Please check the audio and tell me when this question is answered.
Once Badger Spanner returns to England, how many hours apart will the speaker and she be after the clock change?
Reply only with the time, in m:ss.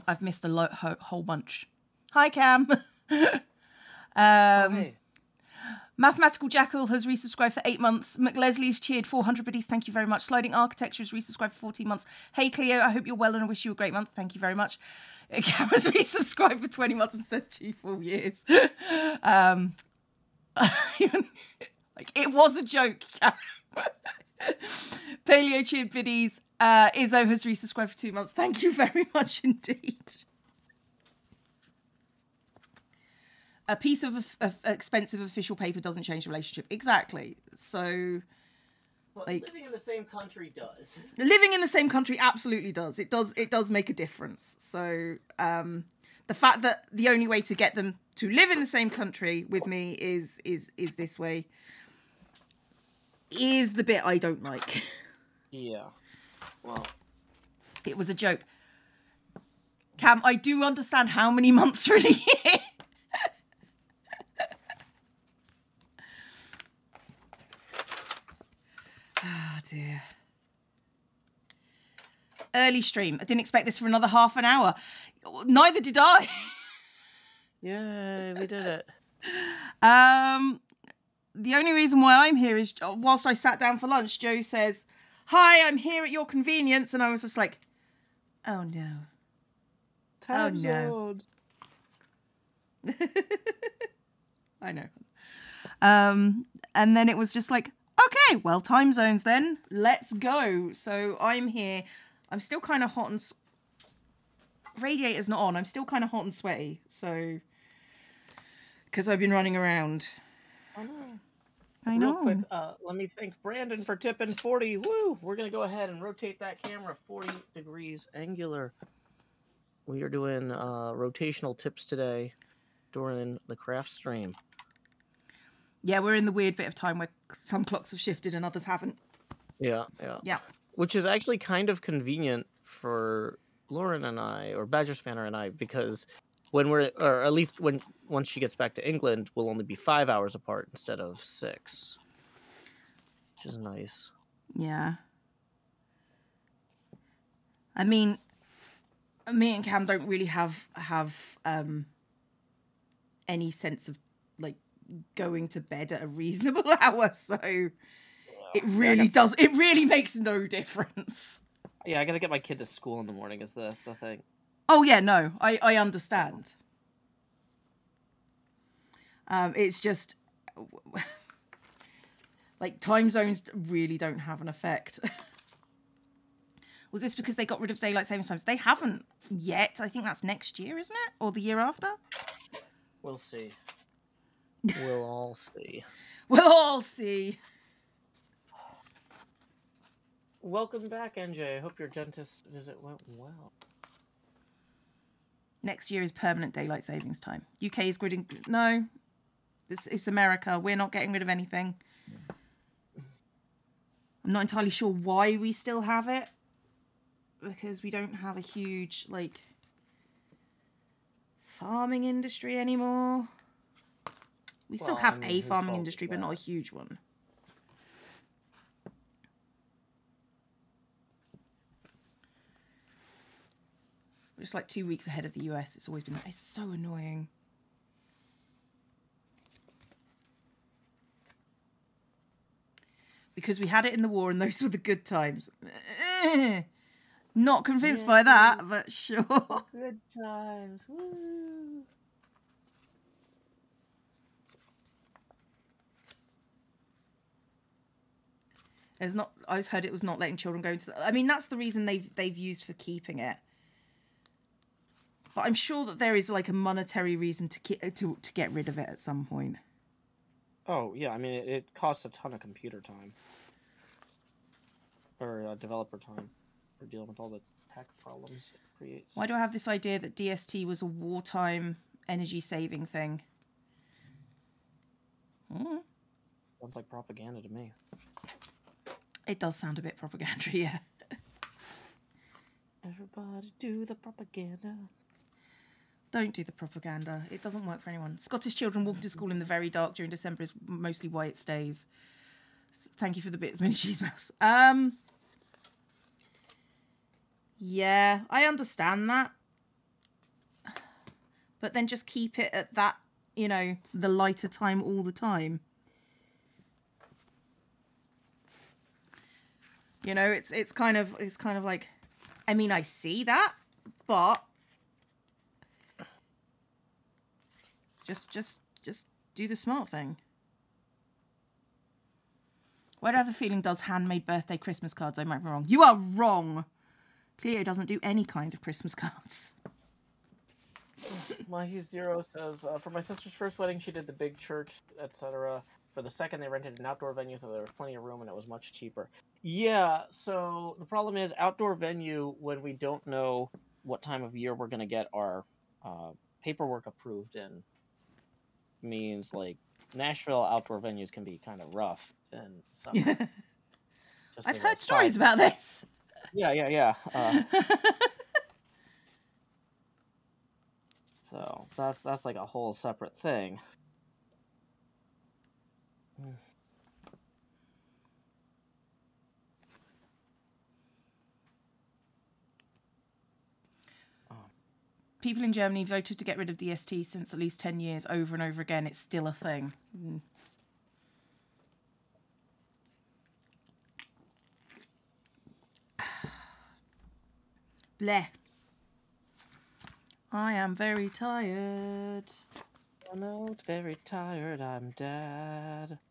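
2:19.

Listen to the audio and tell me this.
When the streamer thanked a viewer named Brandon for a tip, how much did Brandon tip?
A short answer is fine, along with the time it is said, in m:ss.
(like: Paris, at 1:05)
40, at 1:53.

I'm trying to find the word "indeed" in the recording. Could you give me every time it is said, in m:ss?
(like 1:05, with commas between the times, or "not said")
0:29.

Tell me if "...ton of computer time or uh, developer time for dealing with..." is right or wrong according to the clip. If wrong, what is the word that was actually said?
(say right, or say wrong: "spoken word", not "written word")
right.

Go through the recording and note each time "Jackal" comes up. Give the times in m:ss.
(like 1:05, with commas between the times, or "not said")
0:06.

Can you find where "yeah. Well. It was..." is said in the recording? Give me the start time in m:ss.
0:55.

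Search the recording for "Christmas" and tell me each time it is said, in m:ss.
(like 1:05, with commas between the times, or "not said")
5:24, 5:28.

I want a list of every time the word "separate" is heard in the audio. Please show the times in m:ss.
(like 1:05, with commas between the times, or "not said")
6:02.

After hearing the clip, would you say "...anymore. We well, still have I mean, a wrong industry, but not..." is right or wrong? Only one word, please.
wrong.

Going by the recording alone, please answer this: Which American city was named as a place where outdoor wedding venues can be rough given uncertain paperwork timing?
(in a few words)
Nashville.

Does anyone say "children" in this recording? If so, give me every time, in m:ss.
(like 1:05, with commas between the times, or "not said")
4:10, 4:48.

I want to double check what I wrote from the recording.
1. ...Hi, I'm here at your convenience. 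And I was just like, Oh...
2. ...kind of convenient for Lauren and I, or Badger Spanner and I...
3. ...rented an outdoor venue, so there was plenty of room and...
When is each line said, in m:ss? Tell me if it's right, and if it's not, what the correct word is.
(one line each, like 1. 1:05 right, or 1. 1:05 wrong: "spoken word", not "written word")
1. 1:25 right
2. 2:11 right
3. 5:36 right.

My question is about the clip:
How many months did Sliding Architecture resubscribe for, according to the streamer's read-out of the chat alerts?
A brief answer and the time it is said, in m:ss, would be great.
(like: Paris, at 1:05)
14, at 0:11.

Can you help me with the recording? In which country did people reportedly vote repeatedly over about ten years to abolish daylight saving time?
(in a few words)
Germany.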